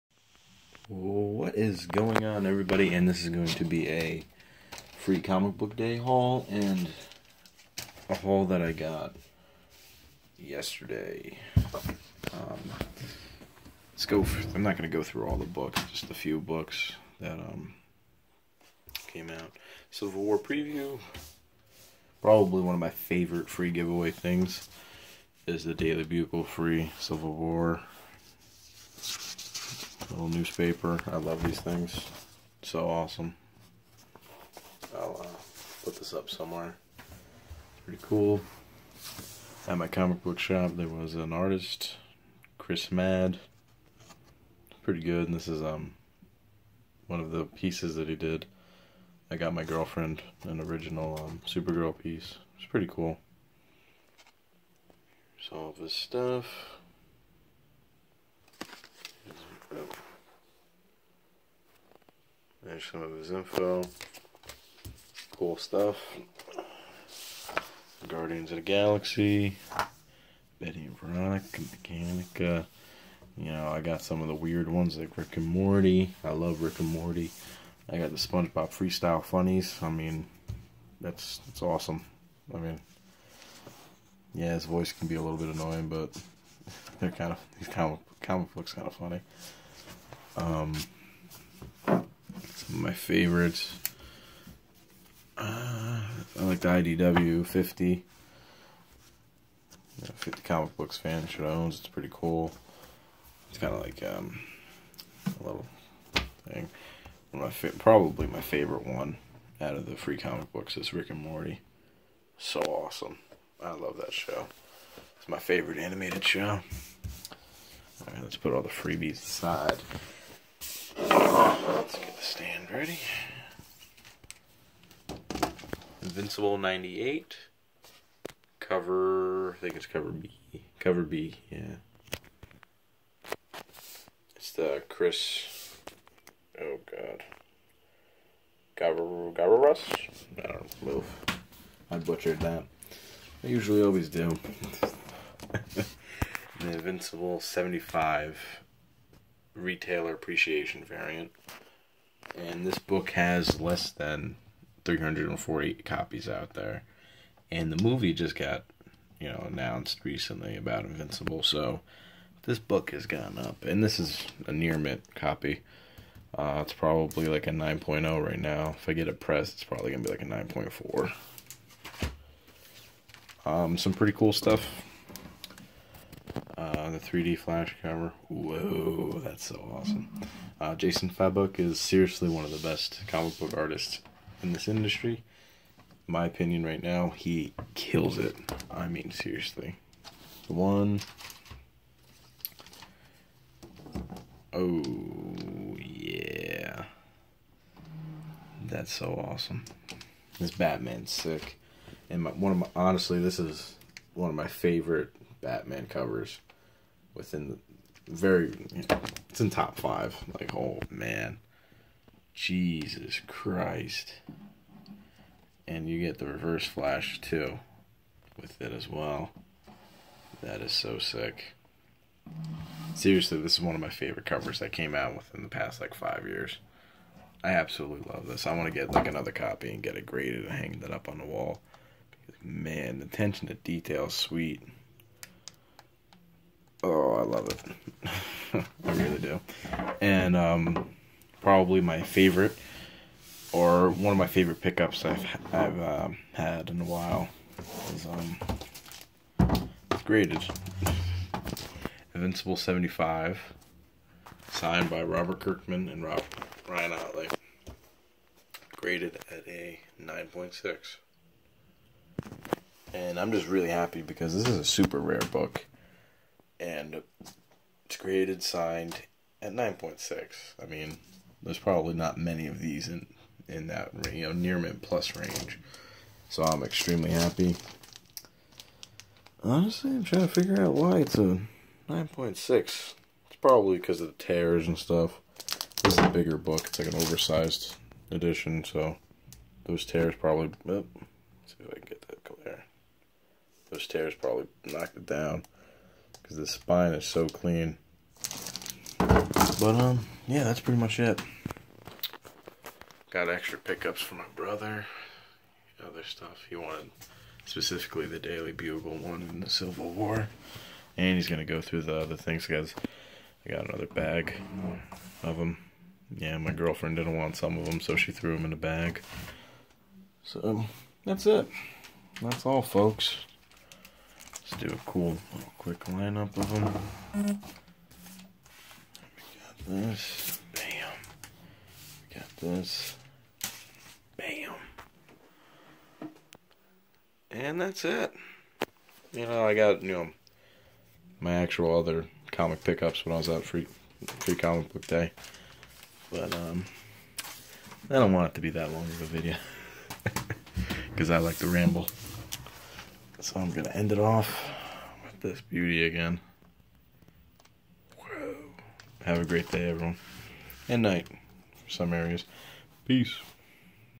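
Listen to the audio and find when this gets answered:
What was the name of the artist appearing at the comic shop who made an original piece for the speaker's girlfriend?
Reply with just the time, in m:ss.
0:42.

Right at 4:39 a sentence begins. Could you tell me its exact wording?
Honestly, I'm trying to figure out why it's a 9.6.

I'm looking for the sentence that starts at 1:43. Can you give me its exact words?
It's kind of like um, a little thing.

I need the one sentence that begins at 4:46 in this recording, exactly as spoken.
It's like an oversized edition, so those tears probably.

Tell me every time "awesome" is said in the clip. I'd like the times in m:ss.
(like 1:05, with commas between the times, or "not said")
0:32, 1:21, 1:52, 2:59, 3:19.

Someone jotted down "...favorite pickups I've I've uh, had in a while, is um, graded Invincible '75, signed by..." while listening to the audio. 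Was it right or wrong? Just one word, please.
right.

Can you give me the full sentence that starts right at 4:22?
And I'm just really happy because this is a super rare book and it's created, signed at 9.6.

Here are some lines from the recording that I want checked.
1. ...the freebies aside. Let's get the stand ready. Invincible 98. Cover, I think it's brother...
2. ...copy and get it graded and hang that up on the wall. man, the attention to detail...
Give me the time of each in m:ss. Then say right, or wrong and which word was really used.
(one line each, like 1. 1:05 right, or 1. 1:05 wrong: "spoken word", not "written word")
1. 1:58 wrong: "cover", not "brother"
2. 3:49 right.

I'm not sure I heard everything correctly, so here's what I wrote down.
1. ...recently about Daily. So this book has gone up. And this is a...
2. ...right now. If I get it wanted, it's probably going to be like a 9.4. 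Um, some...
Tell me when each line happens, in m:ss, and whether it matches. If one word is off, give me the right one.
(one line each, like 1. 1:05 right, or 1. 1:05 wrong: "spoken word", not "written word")
1. 2:40 wrong: "Invincible", not "Daily"
2. 2:48 wrong: "pressed", not "wanted".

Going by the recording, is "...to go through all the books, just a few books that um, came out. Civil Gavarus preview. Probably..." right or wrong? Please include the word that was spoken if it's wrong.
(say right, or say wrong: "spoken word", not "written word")
wrong: "War", not "Gavarus".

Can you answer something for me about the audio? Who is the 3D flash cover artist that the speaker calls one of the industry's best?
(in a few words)
Jason Fabok.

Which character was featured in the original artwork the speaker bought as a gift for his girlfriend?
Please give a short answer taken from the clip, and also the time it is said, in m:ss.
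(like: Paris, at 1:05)
Supergirl, at 0:51.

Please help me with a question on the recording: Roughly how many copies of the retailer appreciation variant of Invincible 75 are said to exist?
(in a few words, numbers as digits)
less than 340.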